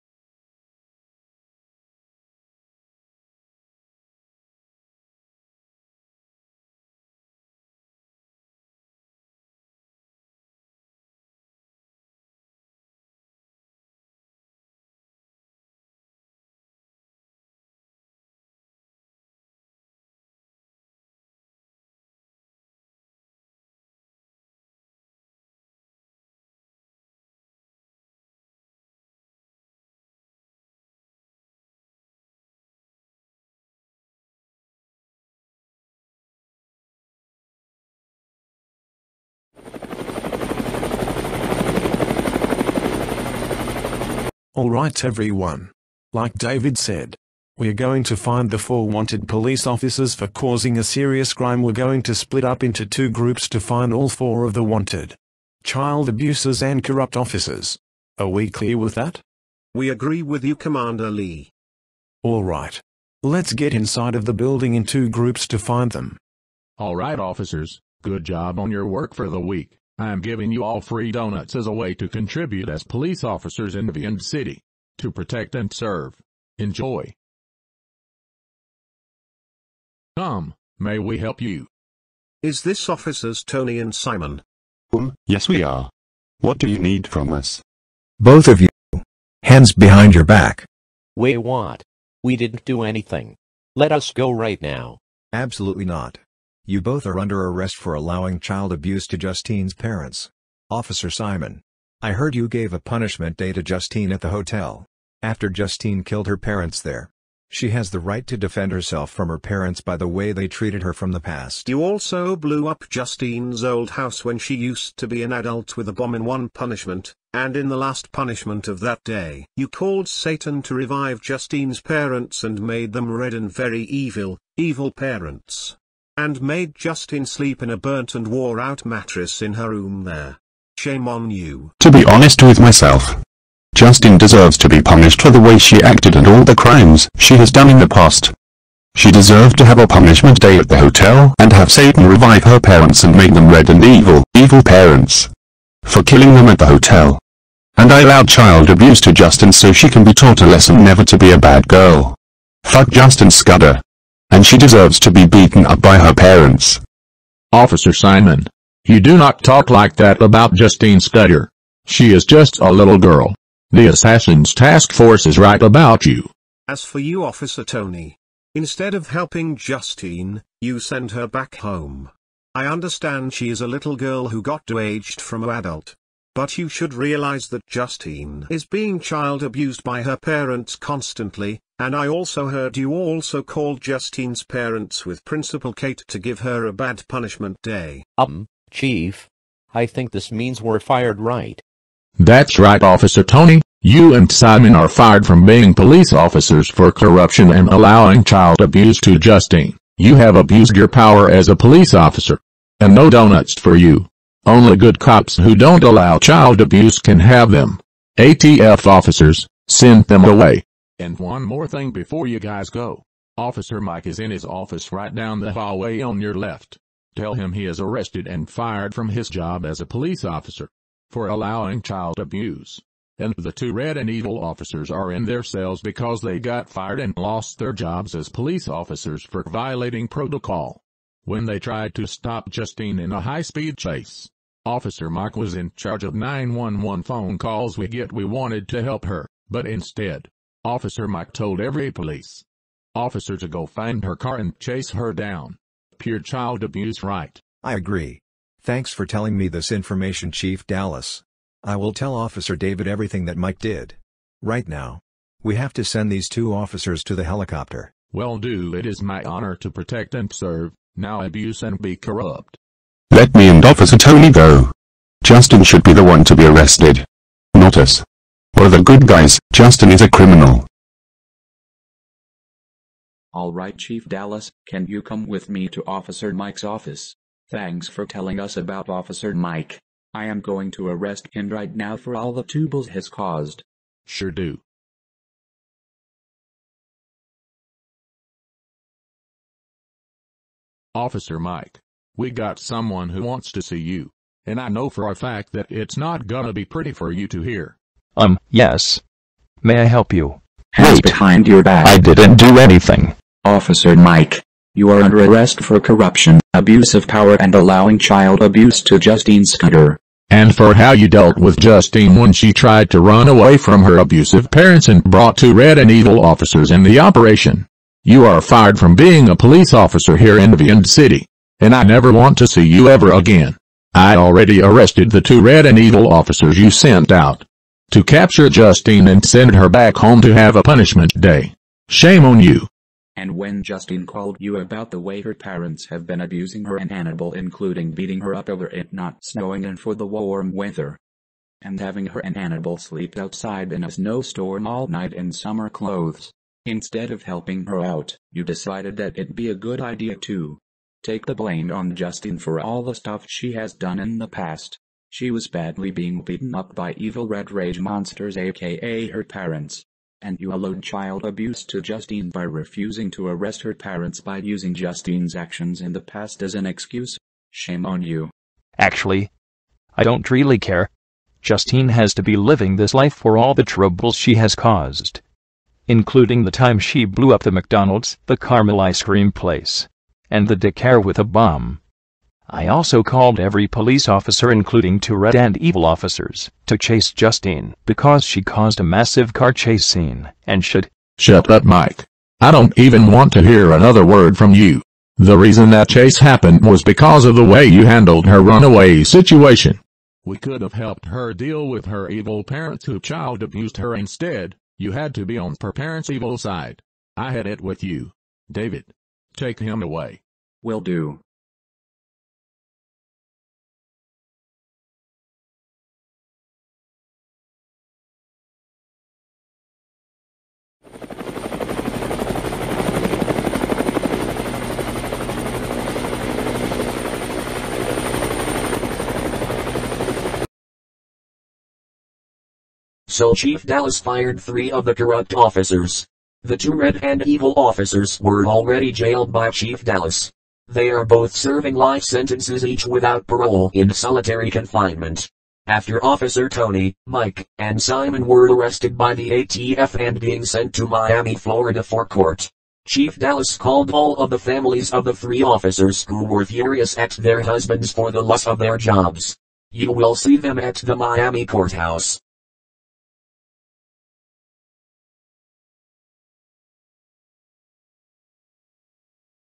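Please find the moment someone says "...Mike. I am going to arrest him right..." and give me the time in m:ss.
4:39.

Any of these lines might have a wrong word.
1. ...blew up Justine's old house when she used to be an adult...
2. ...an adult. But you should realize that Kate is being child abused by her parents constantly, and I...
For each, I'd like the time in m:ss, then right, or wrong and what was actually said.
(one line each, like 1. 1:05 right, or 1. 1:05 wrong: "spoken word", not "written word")
1. 1:52 right
2. 2:55 wrong: "Justine", not "Kate".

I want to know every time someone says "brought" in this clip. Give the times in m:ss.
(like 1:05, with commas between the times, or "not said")
5:15.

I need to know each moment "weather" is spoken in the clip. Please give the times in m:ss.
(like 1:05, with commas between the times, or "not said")
5:40.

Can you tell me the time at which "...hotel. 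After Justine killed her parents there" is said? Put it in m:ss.
1:44.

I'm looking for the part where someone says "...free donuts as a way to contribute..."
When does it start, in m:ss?
1:10.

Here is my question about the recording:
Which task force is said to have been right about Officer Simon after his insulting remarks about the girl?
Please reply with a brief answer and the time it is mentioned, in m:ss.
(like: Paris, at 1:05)
Assassin's Task Force, at 2:43.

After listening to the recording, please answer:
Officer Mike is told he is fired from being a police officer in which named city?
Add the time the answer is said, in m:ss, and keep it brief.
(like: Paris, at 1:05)
Vyond City, at 5:20.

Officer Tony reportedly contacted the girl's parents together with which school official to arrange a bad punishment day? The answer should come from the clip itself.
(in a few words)
Principal Kate.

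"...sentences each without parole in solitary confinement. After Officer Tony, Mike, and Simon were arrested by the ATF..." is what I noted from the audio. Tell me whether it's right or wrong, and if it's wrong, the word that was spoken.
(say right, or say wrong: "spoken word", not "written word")
right.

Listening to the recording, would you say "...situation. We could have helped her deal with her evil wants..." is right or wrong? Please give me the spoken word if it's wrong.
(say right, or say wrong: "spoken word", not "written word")
wrong: "parents", not "wants".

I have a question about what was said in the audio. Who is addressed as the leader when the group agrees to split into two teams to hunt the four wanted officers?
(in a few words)
Commander Lee.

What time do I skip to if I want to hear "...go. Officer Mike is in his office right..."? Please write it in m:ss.
3:32.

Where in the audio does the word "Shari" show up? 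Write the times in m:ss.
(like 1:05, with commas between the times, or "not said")
not said.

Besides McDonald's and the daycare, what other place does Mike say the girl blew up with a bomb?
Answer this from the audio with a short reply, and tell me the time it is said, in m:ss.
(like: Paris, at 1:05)
caramel ice cream place, at 6:18.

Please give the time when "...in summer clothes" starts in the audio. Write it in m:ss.
5:45.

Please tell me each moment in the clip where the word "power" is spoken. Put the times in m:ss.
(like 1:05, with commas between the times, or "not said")
3:20, 5:07.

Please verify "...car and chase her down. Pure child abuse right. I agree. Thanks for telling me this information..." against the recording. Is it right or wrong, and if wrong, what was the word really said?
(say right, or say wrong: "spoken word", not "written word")
right.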